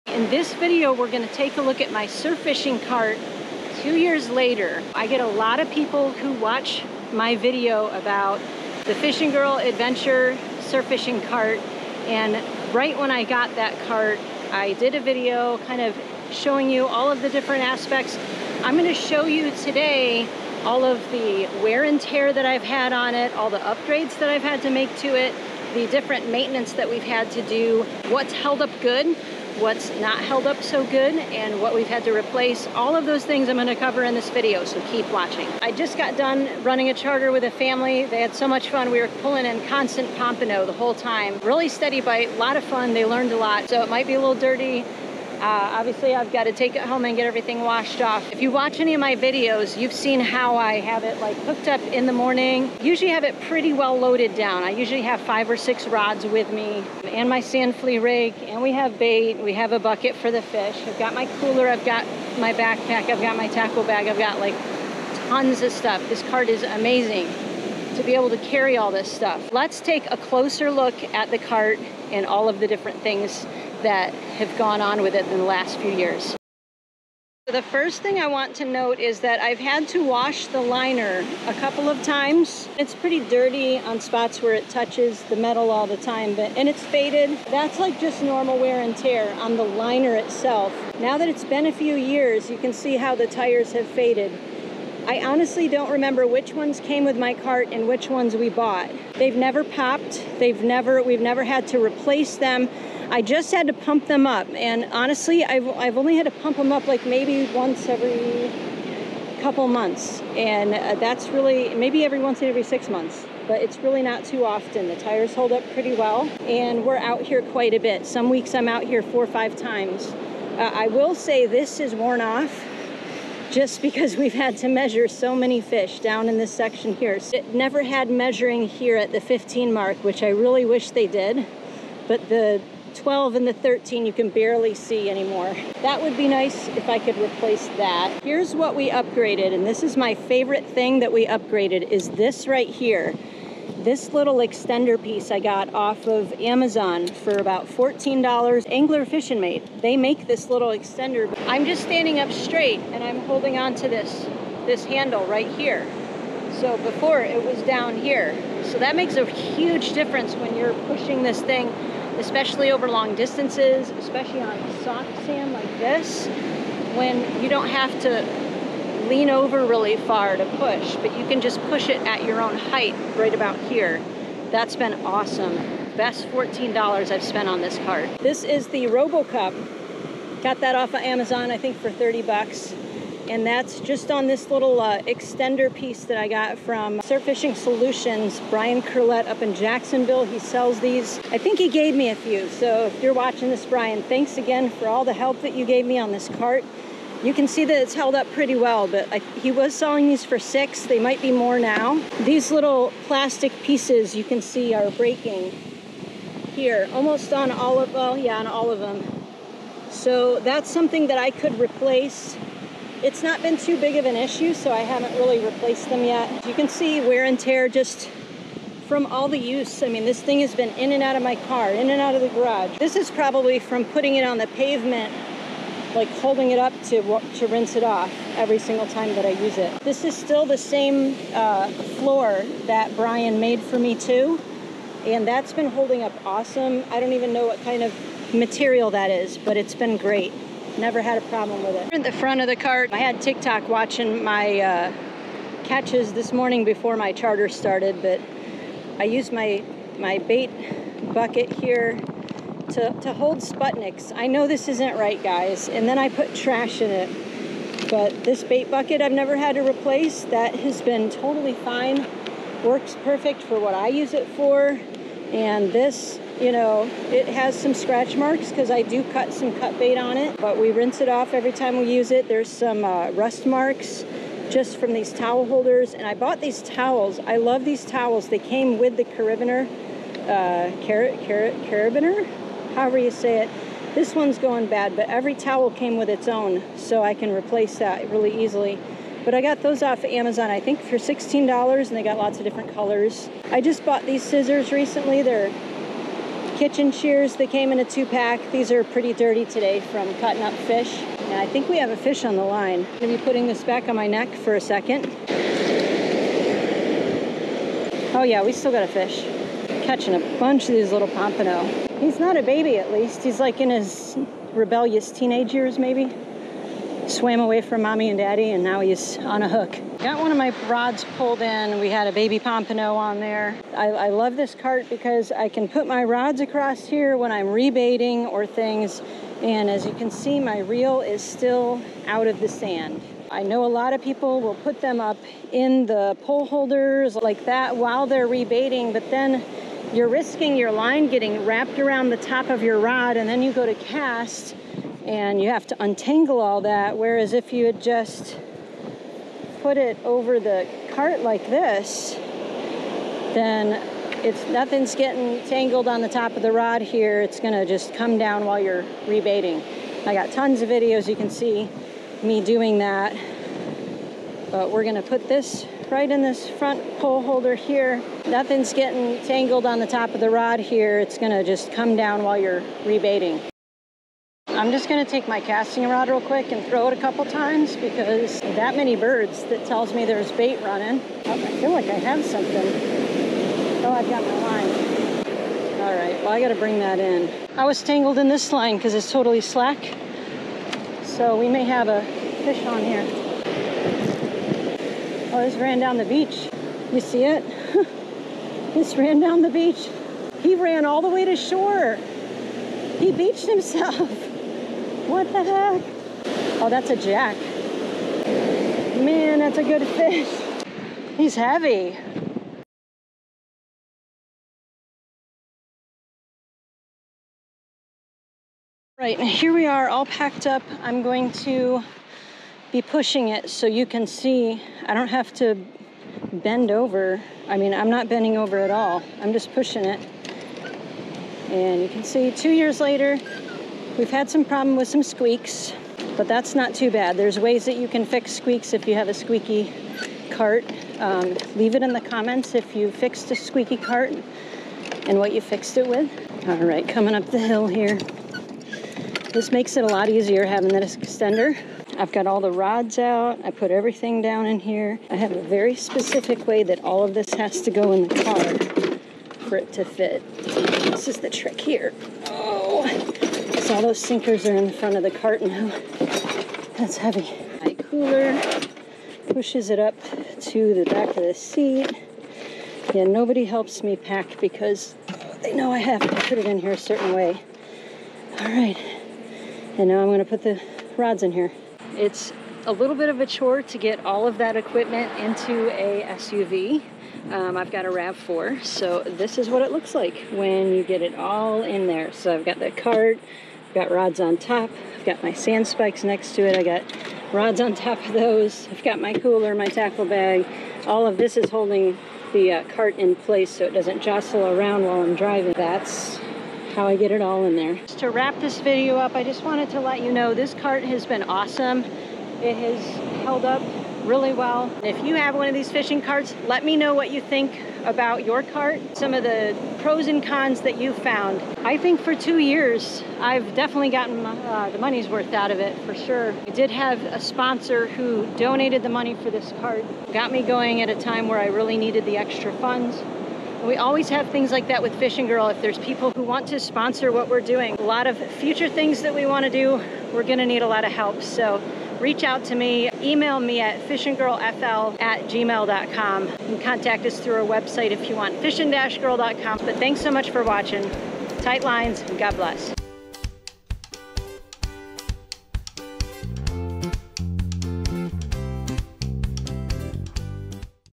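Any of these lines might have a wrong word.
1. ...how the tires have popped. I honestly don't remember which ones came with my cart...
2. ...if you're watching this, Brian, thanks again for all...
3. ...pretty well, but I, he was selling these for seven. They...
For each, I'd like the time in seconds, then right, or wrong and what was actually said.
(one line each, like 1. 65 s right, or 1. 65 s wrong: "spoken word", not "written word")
1. 92 s wrong: "faded", not "popped"
2. 192 s right
3. 198 s wrong: "six", not "seven".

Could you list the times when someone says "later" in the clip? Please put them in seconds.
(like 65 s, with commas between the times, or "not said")
4 s, 432 s.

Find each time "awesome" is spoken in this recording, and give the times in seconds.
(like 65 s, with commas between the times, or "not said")
175 s, 236 s, 511 s.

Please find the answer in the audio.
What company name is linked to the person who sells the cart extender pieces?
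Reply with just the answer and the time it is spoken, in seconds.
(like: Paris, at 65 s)
Surf Fishing Solutions, at 186 s.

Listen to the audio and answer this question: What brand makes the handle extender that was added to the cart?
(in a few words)
Angler Fish-N-Mate.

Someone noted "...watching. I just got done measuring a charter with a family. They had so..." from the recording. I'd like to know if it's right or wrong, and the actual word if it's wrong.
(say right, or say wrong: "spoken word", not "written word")
wrong: "running", not "measuring".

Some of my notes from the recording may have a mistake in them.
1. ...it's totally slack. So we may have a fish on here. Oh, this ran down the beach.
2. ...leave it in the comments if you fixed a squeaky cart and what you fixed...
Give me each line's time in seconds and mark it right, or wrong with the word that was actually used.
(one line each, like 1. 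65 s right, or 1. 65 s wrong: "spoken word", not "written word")
1. 388 s right
2. 441 s right.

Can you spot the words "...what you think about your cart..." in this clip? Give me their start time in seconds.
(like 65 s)
516 s.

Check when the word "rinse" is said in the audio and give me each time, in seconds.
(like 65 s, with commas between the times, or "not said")
227 s, 270 s.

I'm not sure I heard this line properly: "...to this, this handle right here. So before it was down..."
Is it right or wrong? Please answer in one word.
right.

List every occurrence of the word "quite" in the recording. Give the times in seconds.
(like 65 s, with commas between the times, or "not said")
117 s.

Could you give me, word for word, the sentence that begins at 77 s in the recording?
The first thing I want to note is that I've had to wash the liner a couple of times.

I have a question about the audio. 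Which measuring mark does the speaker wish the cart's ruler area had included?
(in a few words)
15.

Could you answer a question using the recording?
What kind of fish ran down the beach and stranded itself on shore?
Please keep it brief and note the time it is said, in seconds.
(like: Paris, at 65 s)
jack, at 406 s.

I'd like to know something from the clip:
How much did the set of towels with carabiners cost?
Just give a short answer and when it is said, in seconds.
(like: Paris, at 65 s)
$16, at 290 s.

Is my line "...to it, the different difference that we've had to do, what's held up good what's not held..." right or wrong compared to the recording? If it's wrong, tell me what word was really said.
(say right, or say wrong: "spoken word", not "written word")
wrong: "maintenance", not "difference".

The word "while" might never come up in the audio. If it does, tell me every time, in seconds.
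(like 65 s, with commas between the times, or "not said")
337 s, 358 s, 372 s, 504 s.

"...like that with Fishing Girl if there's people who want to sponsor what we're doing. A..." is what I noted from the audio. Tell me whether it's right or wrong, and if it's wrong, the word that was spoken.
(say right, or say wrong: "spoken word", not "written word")
right.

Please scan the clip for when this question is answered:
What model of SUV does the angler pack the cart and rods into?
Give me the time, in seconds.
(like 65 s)
487 s.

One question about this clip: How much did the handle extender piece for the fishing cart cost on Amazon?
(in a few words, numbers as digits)
$14.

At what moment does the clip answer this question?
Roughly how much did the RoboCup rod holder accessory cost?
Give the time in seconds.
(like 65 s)
181 s.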